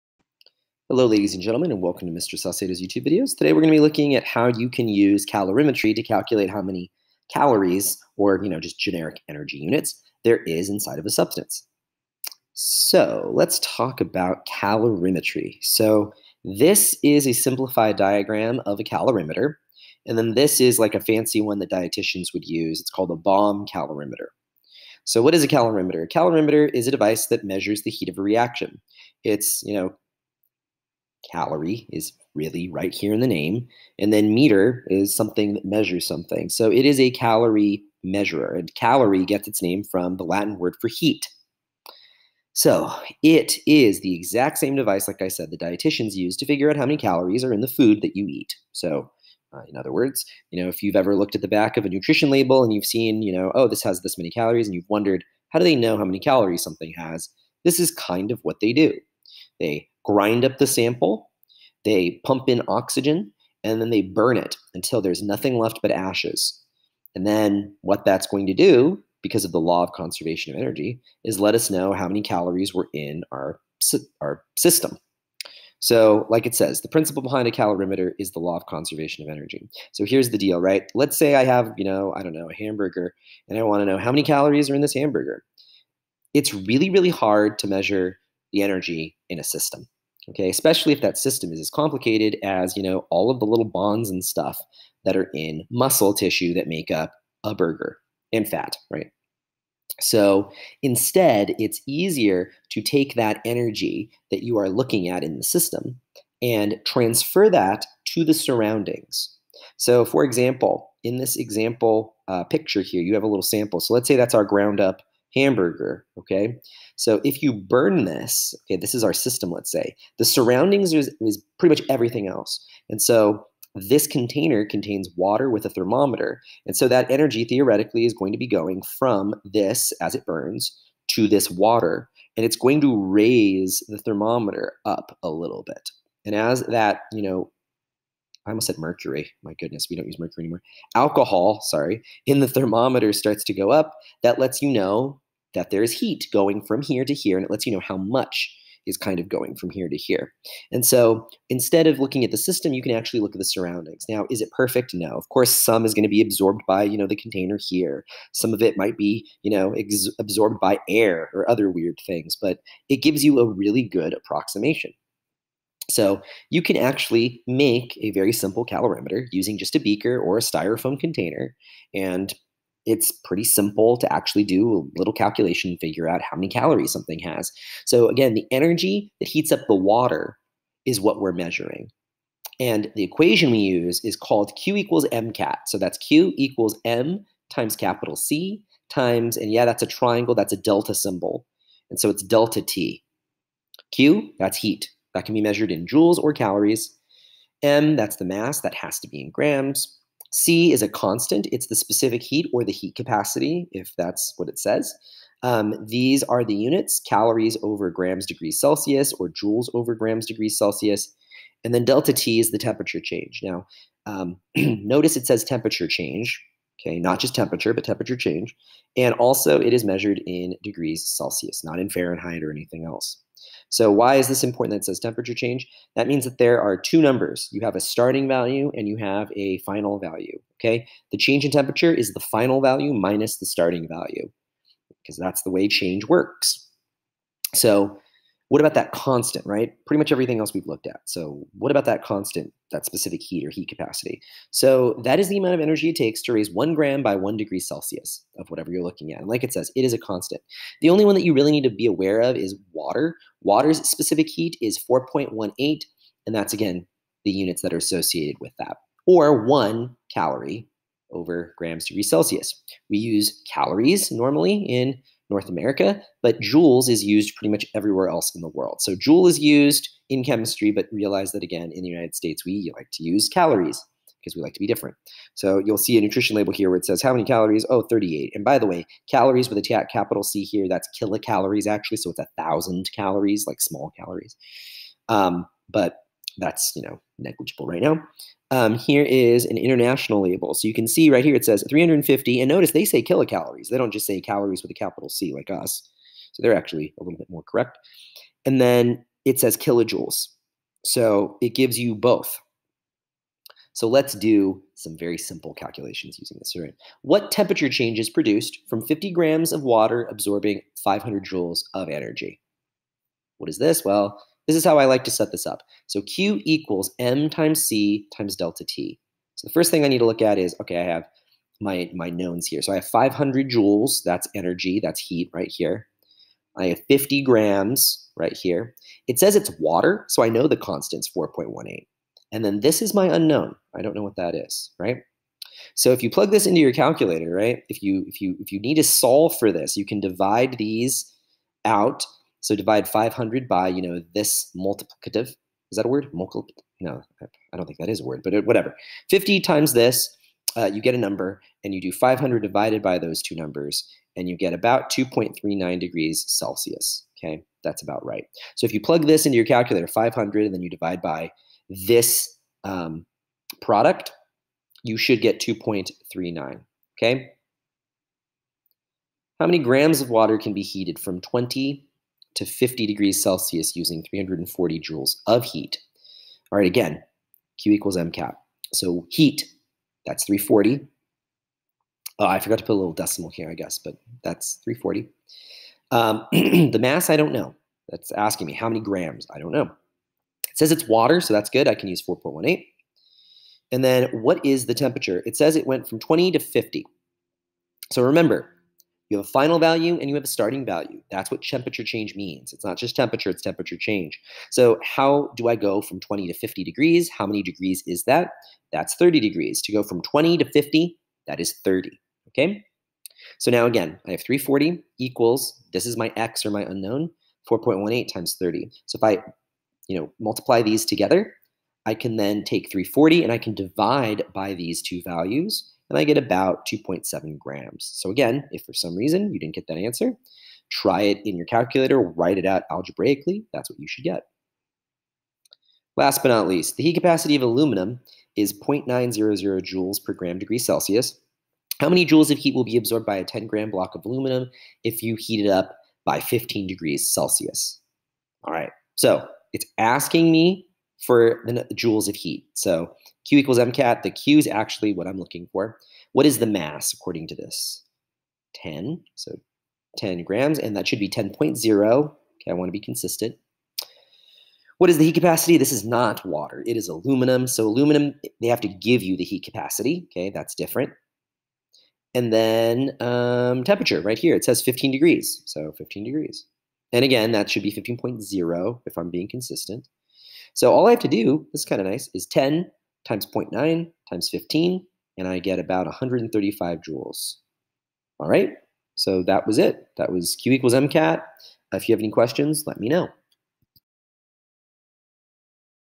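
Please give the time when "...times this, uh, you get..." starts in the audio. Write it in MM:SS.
05:49.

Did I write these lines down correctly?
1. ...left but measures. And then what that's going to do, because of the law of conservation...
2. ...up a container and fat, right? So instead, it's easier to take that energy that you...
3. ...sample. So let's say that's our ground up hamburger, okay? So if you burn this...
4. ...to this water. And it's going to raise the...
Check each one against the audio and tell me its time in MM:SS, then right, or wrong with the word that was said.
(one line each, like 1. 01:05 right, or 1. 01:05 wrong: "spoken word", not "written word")
1. 01:05 wrong: "ashes", not "measures"
2. 01:36 wrong: "burger", not "container"
3. 01:53 right
4. 02:11 right.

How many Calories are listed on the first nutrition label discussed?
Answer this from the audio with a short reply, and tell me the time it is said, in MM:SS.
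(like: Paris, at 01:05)
38, at 04:37.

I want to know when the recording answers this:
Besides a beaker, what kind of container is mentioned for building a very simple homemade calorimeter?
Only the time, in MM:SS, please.
02:50.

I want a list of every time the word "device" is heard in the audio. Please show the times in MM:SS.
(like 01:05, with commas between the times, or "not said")
00:26, 00:44.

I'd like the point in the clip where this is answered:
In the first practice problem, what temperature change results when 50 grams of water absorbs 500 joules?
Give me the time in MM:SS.
05:54.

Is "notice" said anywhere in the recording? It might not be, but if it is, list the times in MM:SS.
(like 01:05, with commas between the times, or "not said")
03:34, 04:52.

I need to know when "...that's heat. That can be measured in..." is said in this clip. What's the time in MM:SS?
03:14.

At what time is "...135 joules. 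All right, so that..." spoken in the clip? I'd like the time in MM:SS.
08:05.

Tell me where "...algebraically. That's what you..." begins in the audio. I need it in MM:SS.
07:12.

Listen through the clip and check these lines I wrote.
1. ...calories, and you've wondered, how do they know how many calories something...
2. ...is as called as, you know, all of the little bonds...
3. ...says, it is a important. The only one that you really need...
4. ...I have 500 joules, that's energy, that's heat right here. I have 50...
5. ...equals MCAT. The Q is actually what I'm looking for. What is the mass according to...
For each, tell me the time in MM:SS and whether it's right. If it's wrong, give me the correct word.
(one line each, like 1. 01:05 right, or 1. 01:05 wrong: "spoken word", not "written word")
1. 00:54 right
2. 01:31 wrong: "complicated", not "called"
3. 04:09 wrong: "constant", not "important"
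4. 05:22 right
5. 07:33 right.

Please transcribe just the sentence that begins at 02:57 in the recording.
So, again, the energy that heats up the water is what we're measuring.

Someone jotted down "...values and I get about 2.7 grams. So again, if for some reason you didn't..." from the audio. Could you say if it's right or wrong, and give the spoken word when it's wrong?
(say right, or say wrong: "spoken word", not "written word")
right.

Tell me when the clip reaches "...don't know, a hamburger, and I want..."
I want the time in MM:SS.
01:22.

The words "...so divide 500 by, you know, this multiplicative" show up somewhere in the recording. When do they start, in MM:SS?
05:42.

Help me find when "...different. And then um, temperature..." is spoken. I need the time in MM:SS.
07:50.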